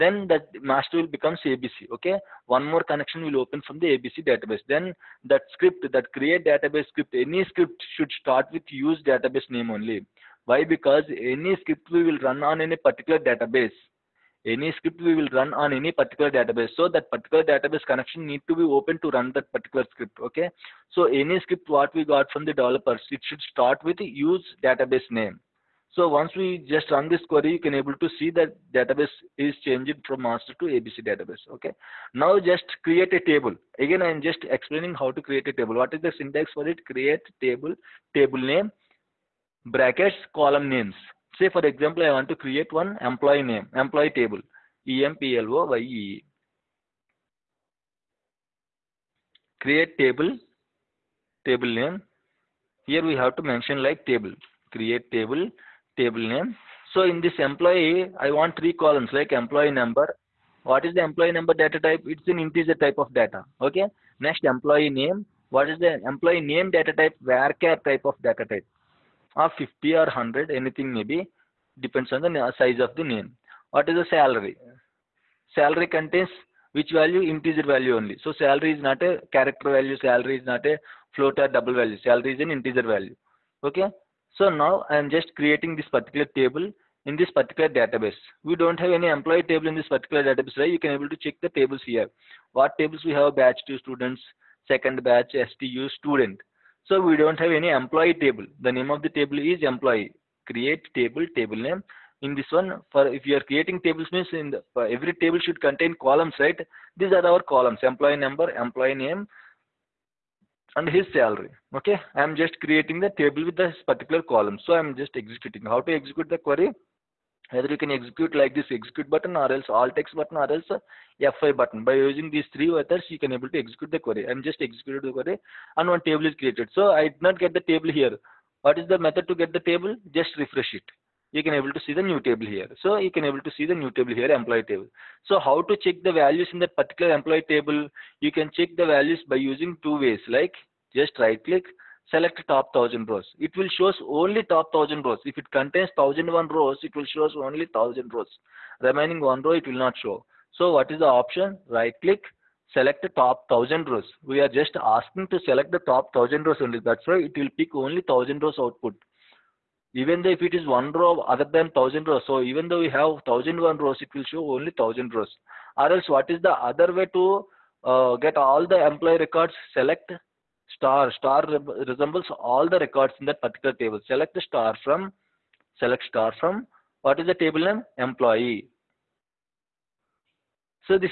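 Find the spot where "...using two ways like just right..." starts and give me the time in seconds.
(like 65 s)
139 s.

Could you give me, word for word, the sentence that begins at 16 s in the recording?
So that particular database connection need to be open to run that particular script.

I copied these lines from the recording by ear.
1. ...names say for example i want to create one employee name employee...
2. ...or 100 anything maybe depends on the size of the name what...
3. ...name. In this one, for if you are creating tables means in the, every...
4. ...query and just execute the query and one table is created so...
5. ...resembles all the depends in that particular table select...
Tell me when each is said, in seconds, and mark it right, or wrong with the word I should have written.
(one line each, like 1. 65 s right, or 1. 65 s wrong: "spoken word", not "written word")
1. 40 s right
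2. 69 s right
3. 101 s right
4. 123 s right
5. 171 s wrong: "records", not "depends".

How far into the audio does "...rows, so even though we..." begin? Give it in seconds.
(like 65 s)
162 s.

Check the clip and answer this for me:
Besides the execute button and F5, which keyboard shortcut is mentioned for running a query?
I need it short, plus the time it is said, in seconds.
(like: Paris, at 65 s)
Alt X, at 119 s.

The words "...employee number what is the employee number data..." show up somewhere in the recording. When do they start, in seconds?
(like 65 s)
59 s.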